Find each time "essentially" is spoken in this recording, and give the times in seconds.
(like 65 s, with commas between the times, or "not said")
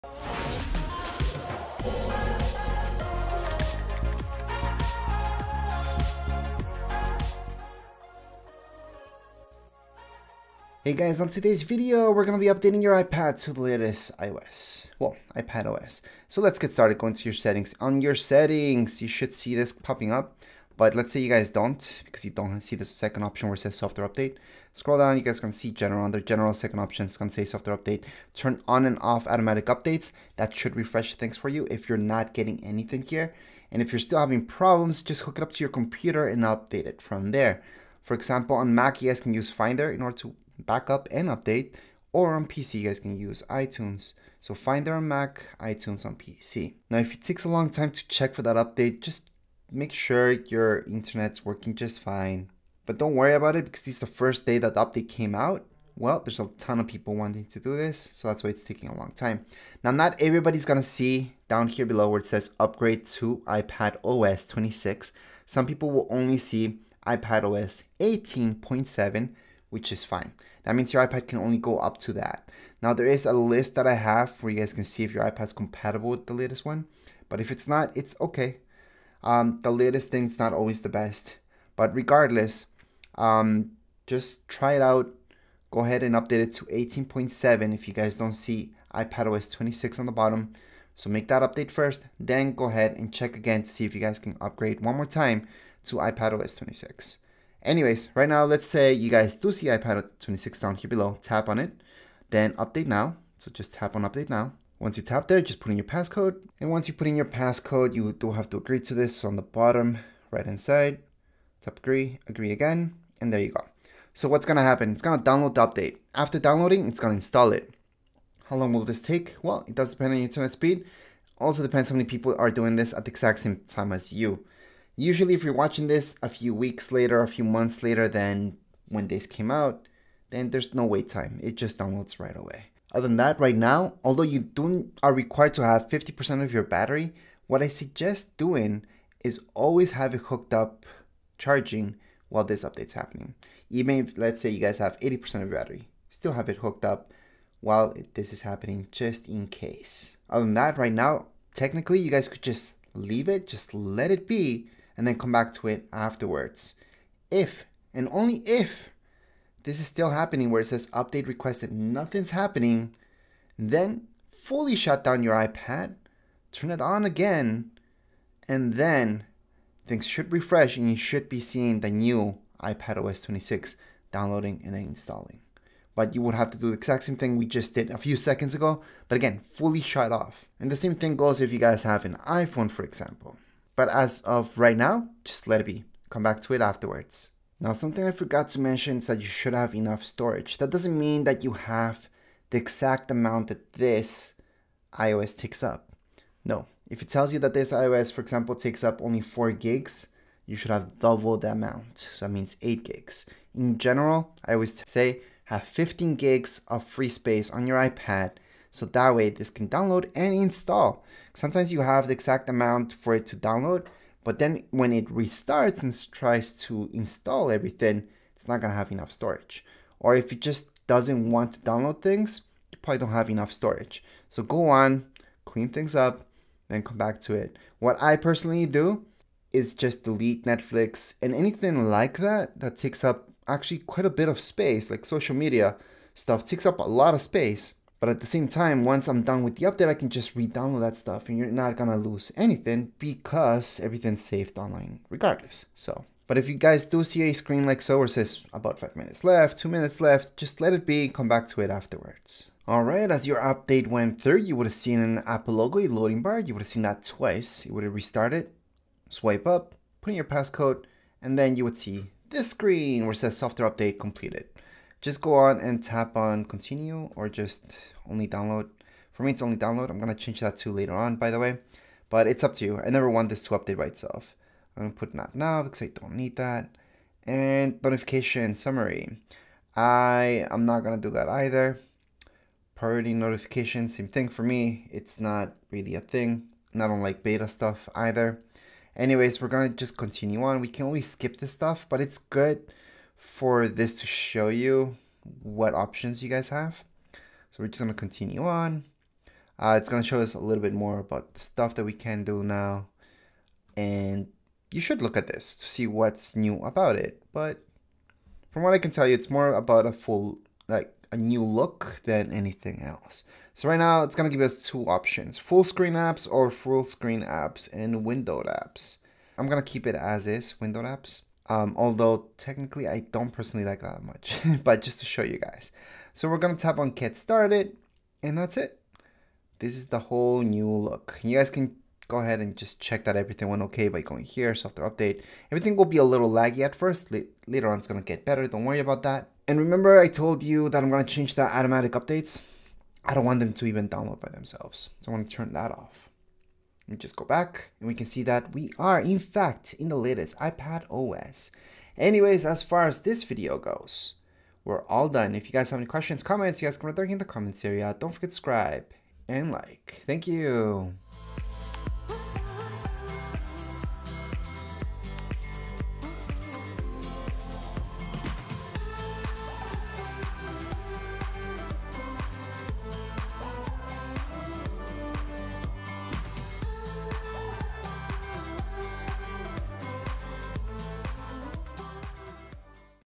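not said.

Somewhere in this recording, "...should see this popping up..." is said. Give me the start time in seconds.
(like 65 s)
19 s.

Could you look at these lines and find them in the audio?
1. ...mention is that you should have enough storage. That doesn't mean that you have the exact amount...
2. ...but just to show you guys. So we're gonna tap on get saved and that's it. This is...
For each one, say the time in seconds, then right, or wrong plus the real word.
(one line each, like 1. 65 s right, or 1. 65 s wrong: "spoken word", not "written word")
1. 188 s right
2. 324 s wrong: "started", not "saved".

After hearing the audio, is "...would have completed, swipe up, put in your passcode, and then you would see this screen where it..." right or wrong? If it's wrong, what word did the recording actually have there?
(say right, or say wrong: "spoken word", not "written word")
wrong: "restarted", not "completed".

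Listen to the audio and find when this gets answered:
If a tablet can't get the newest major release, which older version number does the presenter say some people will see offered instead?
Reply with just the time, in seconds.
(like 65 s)
67 s.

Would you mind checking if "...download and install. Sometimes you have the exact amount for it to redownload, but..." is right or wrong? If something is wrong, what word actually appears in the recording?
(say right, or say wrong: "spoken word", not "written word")
wrong: "download", not "redownload".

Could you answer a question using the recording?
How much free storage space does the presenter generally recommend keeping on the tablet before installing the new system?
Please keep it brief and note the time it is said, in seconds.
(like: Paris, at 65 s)
15 gigs, at 205 s.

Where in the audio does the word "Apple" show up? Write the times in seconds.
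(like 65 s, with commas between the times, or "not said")
255 s.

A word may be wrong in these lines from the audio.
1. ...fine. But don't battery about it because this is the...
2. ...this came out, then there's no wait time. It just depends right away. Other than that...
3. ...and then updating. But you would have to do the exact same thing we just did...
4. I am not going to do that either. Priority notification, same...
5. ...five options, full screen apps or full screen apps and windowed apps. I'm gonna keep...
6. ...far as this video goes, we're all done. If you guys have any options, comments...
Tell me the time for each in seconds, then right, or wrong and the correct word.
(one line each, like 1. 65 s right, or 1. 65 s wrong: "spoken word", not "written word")
1. 52 s wrong: "worry", not "battery"
2. 129 s wrong: "downloads", not "depends"
3. 174 s wrong: "installing", not "updating"
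4. 279 s right
5. 314 s wrong: "two", not "five"
6. 352 s wrong: "questions", not "options".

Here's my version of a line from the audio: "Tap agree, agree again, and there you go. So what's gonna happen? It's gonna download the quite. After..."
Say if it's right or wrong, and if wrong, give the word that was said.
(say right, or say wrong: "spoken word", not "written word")
wrong: "update", not "quite".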